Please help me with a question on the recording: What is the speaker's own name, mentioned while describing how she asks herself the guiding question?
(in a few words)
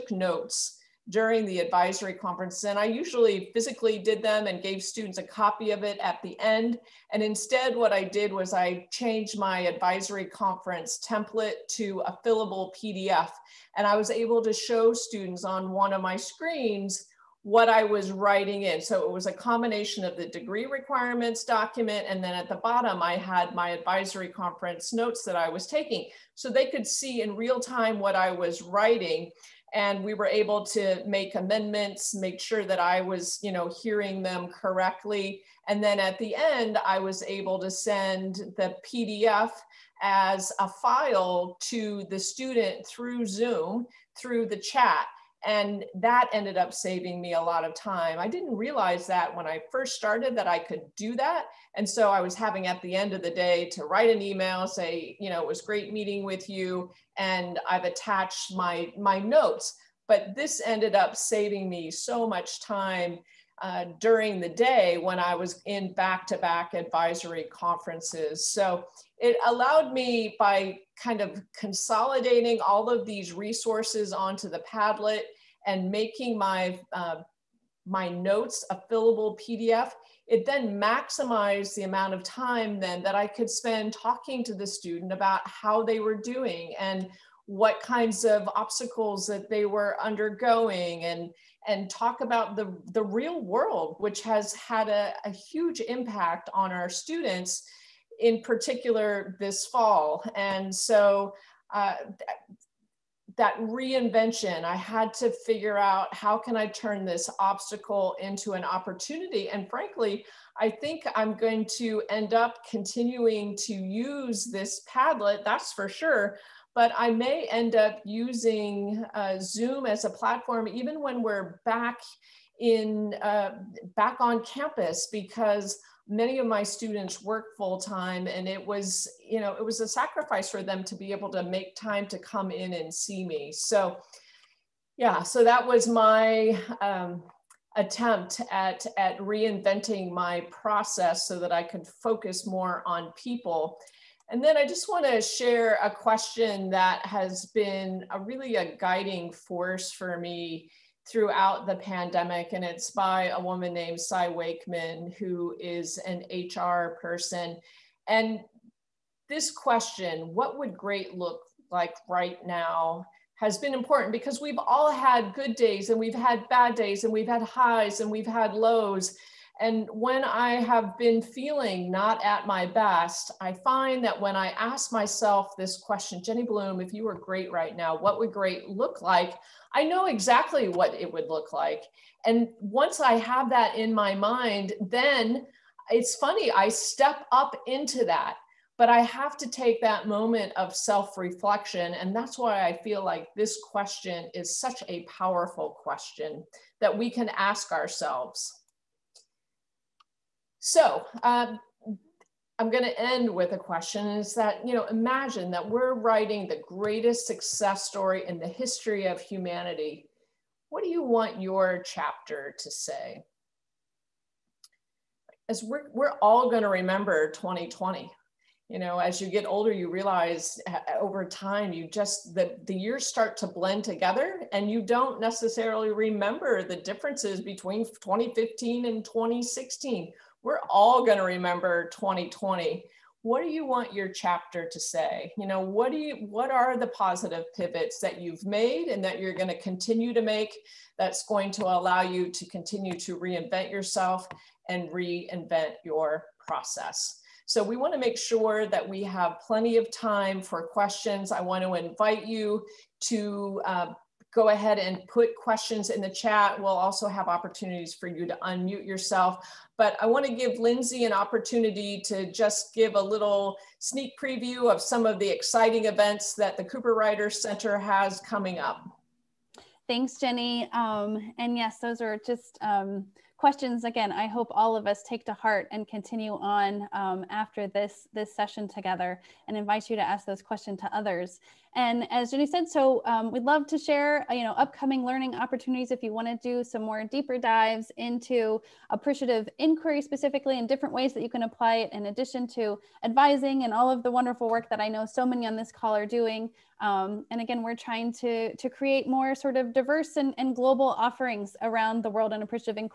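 Jenny Bloom.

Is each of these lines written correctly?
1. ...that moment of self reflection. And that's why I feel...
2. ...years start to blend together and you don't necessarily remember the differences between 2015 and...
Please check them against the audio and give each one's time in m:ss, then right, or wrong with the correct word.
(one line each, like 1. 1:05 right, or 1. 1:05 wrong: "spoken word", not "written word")
1. 3:09 right
2. 3:42 right.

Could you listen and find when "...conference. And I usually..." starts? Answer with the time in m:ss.
0:02.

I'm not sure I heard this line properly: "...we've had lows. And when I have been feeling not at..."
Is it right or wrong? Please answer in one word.
right.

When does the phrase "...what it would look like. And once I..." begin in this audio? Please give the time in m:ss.
3:00.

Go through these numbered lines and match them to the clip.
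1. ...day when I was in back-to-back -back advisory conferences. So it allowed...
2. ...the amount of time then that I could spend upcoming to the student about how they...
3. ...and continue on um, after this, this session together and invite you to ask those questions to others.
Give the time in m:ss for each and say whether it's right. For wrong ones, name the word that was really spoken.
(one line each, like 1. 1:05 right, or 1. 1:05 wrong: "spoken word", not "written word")
1. 1:04 right
2. 1:21 wrong: "talking", not "upcoming"
3. 4:35 right.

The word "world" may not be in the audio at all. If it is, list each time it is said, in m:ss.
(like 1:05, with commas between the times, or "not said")
1:33, 5:02.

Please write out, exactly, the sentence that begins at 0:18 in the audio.
So it was a combination of the degree requirements document.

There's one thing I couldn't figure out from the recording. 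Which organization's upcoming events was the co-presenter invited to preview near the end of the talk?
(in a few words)
Cooperrider Center.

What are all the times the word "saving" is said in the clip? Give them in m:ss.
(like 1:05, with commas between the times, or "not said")
0:46, 1:01.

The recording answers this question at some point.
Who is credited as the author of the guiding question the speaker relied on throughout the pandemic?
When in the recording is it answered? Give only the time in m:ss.
2:33.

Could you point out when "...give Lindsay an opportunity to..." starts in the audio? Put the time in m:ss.
4:20.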